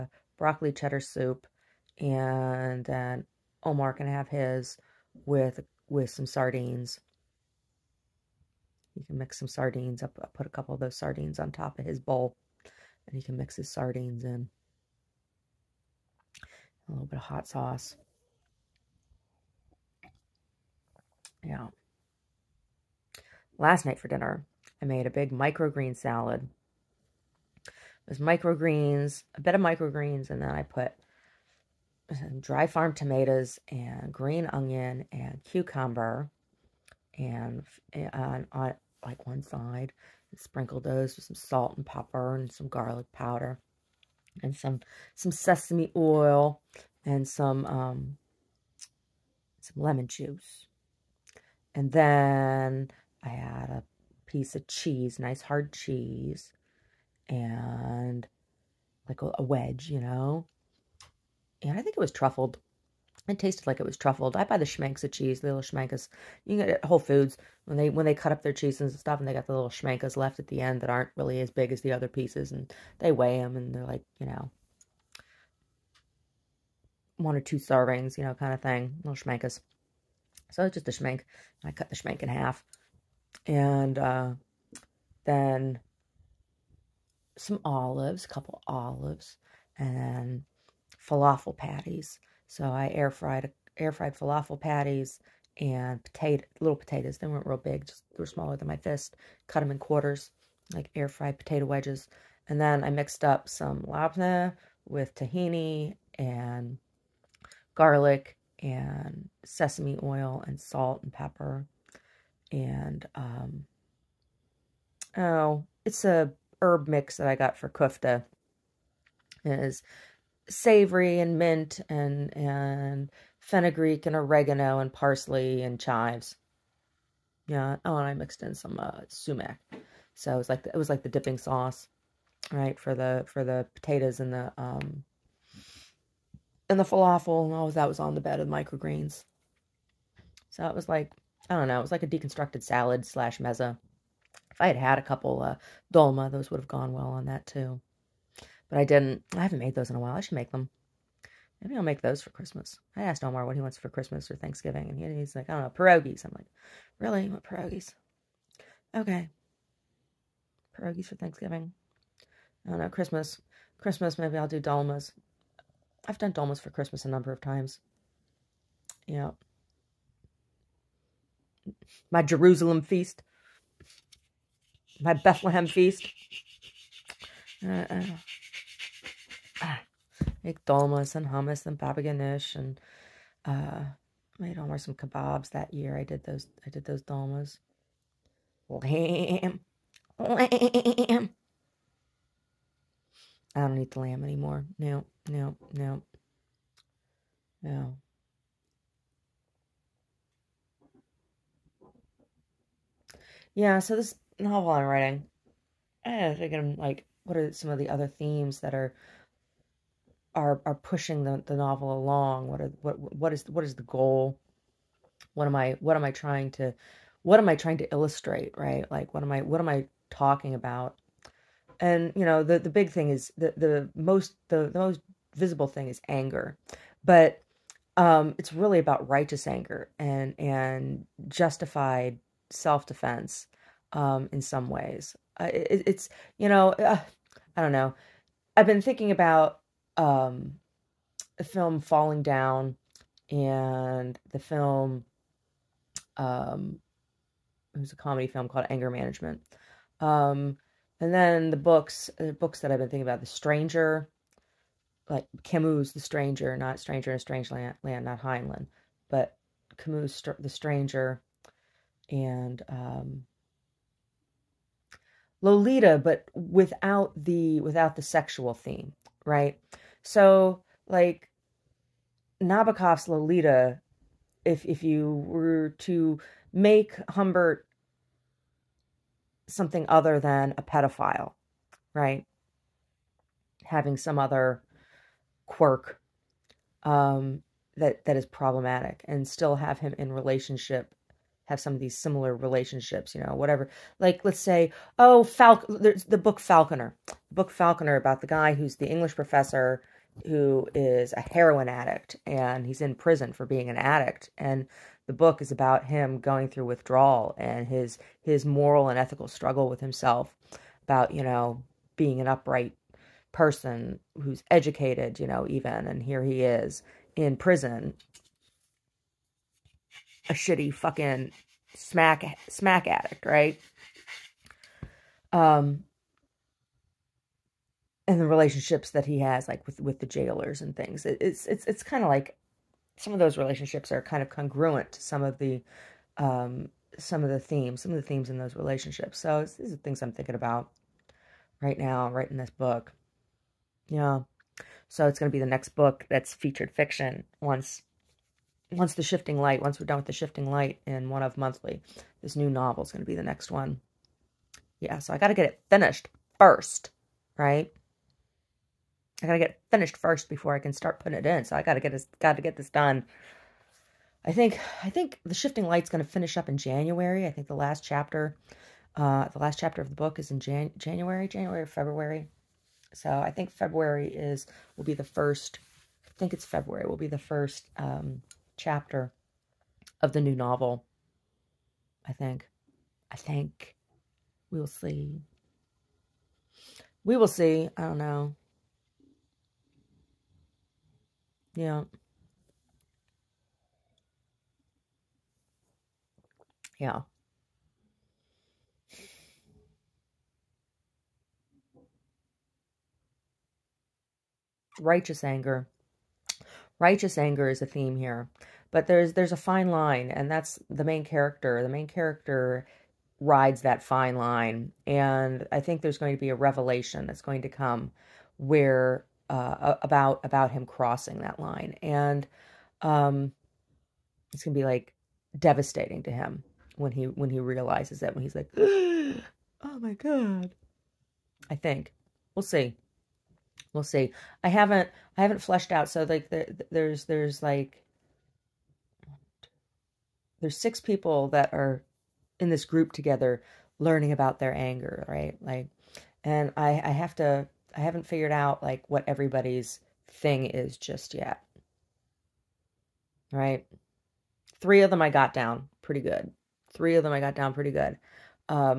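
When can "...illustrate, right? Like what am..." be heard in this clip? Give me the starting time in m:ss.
3:37.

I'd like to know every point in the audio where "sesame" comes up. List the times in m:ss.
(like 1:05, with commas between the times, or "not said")
0:45, 1:49.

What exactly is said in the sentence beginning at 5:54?
Yeah, so I got to get it finished first, right?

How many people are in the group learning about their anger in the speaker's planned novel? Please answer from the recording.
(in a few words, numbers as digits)
6.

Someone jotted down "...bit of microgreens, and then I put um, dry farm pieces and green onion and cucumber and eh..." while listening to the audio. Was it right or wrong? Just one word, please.
wrong.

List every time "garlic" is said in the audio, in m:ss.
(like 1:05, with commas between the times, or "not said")
0:42, 1:47.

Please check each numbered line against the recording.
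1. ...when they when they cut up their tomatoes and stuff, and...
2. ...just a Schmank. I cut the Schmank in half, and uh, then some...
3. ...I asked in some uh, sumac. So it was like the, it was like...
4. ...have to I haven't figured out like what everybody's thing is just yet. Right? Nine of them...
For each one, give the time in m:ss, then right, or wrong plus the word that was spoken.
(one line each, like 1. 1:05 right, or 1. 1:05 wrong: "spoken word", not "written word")
1. 1:07 wrong: "cheeses", not "tomatoes"
2. 1:20 right
3. 2:08 wrong: "mixed", not "asked"
4. 7:26 wrong: "Three", not "Nine".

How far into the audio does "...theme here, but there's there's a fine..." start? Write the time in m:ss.
6:47.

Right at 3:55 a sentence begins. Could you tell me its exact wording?
Uh, it, it's, you know, uh, I don't know.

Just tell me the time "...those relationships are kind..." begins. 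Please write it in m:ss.
5:33.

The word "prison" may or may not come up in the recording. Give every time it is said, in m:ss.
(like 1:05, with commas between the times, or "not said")
5:02, 5:17.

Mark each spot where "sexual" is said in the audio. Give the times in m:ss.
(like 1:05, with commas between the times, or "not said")
4:28.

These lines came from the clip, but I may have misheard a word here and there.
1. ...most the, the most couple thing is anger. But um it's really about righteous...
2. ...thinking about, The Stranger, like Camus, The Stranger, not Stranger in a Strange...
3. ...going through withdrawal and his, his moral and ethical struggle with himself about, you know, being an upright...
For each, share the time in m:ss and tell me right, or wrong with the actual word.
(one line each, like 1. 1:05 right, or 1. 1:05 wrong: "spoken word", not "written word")
1. 3:43 wrong: "visible", not "couple"
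2. 4:12 right
3. 5:06 right.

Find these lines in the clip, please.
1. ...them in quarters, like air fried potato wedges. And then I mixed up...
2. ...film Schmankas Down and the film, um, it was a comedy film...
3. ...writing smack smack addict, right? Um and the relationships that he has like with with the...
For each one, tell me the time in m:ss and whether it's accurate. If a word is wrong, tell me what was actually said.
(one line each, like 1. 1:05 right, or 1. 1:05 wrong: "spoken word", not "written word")
1. 1:39 right
2. 4:01 wrong: "Falling", not "Schmankas"
3. 5:20 wrong: "fucking", not "writing".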